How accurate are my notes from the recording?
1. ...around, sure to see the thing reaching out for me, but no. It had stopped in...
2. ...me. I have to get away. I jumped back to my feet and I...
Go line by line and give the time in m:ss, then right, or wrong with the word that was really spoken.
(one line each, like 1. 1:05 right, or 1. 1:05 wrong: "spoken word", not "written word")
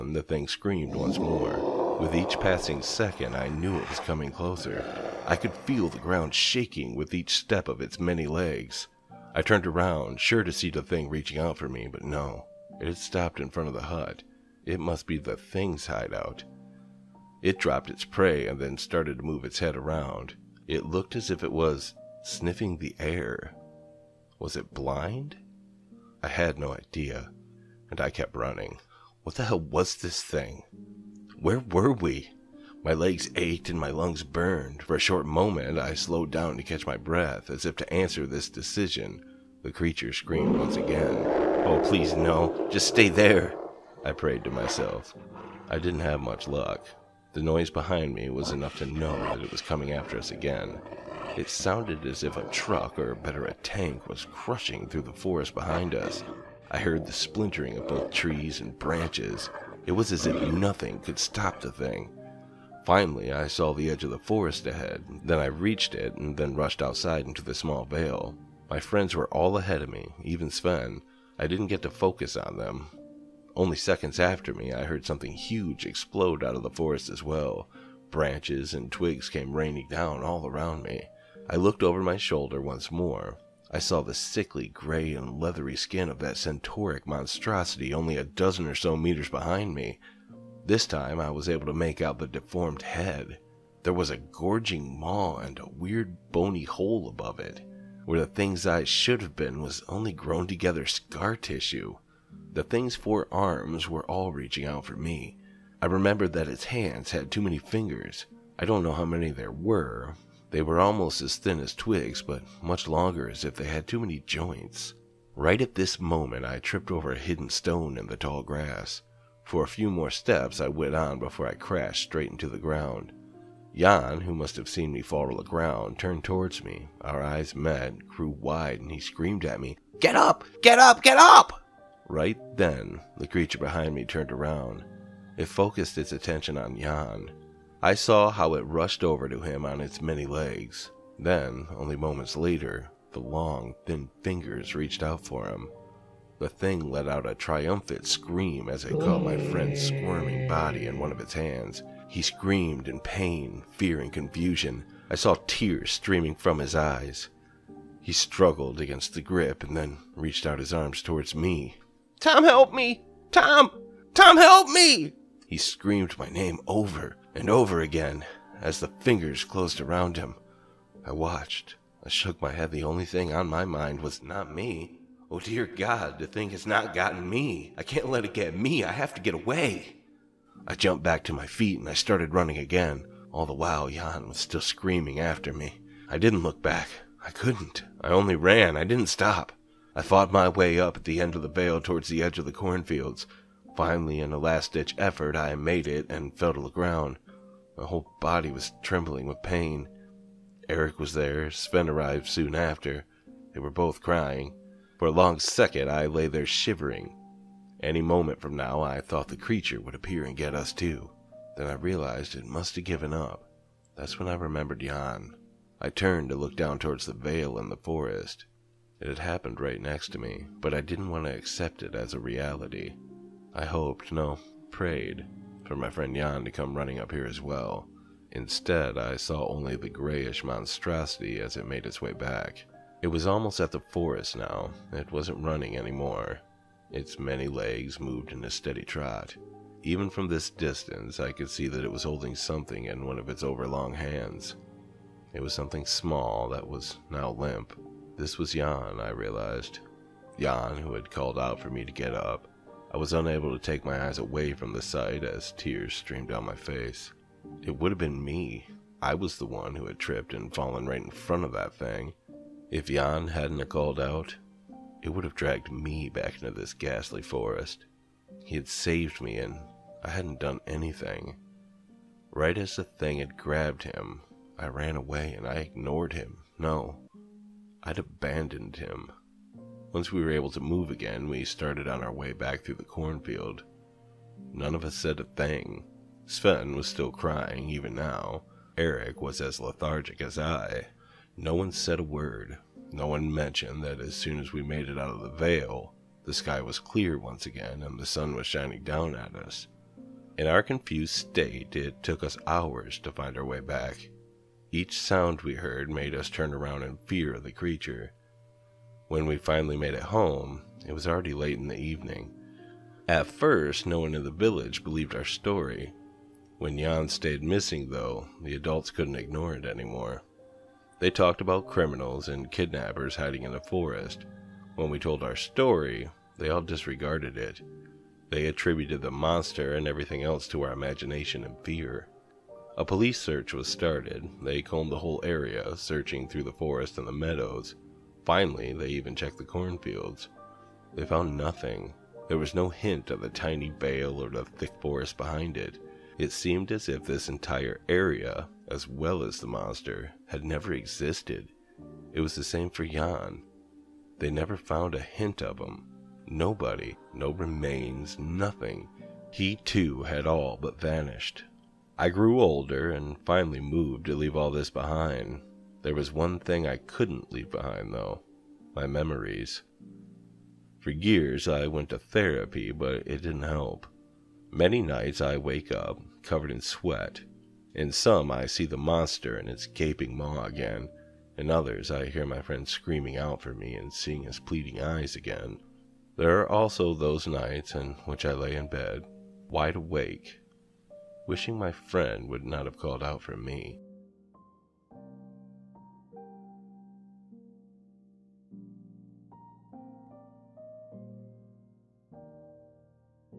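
1. 0:09 right
2. 2:58 right.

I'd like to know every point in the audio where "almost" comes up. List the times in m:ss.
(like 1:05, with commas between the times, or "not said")
1:50, 3:53.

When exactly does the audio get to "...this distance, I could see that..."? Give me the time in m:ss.
4:00.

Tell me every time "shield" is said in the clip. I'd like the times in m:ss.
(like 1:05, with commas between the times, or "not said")
not said.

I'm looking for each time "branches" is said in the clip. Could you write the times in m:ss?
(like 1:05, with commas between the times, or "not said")
0:58, 1:18.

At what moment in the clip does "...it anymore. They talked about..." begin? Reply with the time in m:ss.
5:19.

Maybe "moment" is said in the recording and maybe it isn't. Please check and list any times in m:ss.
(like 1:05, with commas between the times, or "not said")
0:35, 1:55, 2:21, 3:28.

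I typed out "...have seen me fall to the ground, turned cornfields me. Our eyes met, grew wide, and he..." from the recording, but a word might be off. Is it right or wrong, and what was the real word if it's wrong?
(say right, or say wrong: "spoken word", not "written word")
wrong: "towards", not "cornfields".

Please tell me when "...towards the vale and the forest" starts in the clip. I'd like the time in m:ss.
3:36.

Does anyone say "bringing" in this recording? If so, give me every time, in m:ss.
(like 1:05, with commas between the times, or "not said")
not said.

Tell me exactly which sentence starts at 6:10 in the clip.
For years, I went to therapy, but it didn't help.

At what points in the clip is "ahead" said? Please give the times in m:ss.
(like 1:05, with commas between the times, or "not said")
1:04, 1:09.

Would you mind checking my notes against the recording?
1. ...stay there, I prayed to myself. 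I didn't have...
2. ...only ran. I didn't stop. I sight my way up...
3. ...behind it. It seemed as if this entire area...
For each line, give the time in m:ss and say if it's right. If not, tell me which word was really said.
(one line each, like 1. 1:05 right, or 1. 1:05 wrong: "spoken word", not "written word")
1. 0:42 right
2. 3:08 wrong: "fought", not "sight"
3. 5:45 right.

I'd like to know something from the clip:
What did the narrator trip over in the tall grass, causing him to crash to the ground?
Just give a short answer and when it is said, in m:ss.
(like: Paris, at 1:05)
a hidden stone, at 1:57.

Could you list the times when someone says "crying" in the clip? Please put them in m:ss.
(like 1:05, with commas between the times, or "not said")
3:24, 4:47.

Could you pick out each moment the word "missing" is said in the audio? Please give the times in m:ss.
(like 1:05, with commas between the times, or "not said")
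5:17.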